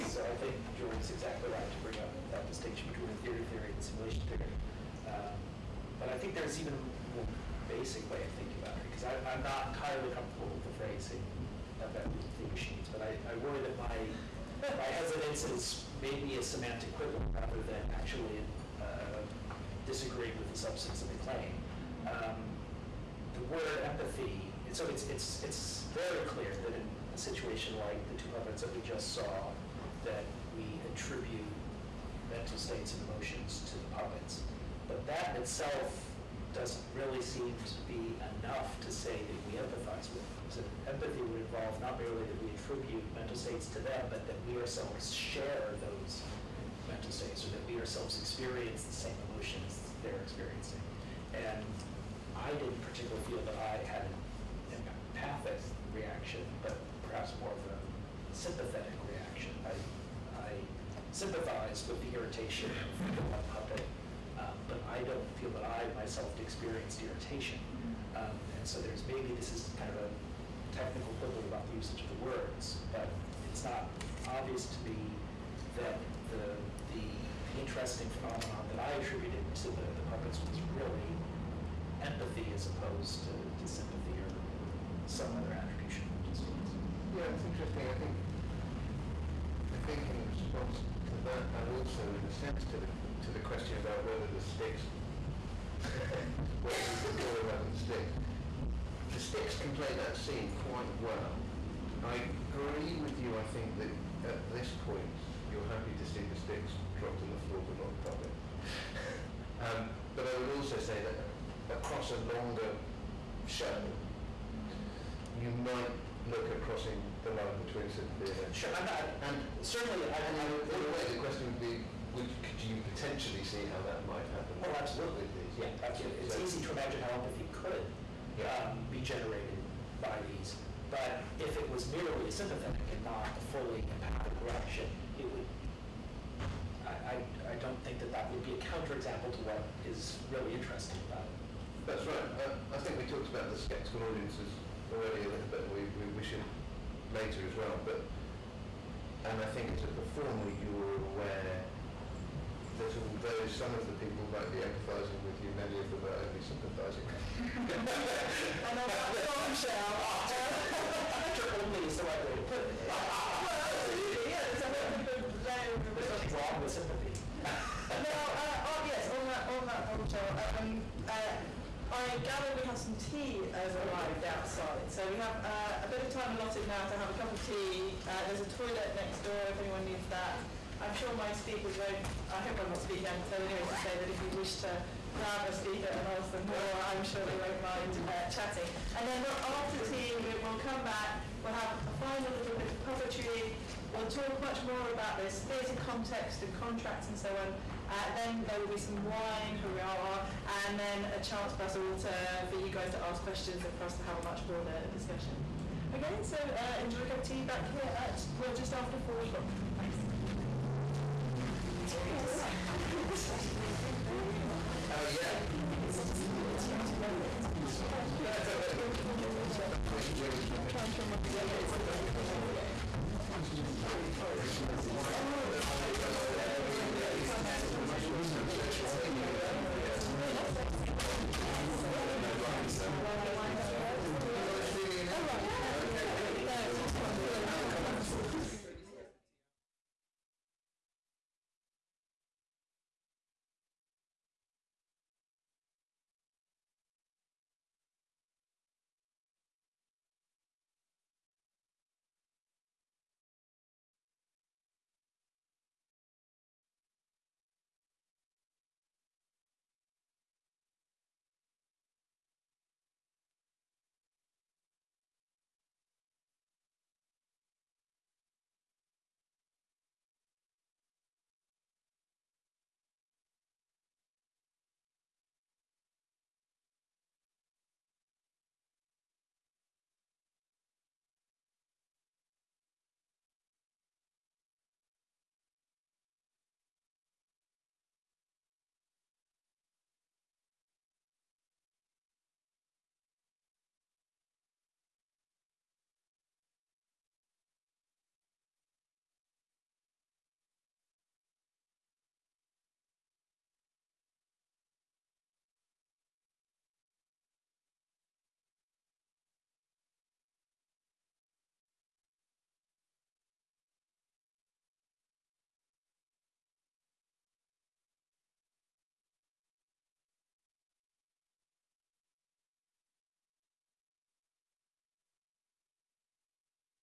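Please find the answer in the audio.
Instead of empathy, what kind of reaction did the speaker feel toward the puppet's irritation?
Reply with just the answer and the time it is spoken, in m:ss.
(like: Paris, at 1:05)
Sympathetic reaction, at 0:58.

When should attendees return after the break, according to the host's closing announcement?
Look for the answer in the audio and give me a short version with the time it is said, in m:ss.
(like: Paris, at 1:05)
Just after four o'clock, at 3:28.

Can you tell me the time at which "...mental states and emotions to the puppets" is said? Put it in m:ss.
0:32.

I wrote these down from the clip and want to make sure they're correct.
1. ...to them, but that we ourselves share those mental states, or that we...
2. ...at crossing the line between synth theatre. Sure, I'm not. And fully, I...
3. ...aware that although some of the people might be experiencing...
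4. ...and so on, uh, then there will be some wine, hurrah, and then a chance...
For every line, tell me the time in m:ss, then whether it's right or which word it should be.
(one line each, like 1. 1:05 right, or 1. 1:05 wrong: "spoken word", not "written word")
1. 0:43 right
2. 1:56 wrong: "certainly", not "fully"
3. 2:31 wrong: "empathising", not "experiencing"
4. 3:17 right.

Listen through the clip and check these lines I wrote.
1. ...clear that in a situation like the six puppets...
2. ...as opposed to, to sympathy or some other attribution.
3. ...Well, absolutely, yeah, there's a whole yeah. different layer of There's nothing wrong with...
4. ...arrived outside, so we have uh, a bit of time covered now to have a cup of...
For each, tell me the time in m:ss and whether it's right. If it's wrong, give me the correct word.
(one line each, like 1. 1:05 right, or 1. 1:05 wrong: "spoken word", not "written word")
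1. 0:26 wrong: "two", not "six"
2. 1:22 right
3. 2:43 right
4. 2:53 wrong: "allotted", not "covered".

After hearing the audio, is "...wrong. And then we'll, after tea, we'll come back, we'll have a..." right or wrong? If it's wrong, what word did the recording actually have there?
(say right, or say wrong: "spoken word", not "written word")
wrong: "chatting", not "wrong".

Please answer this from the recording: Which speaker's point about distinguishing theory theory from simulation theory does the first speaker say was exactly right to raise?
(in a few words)
Joel.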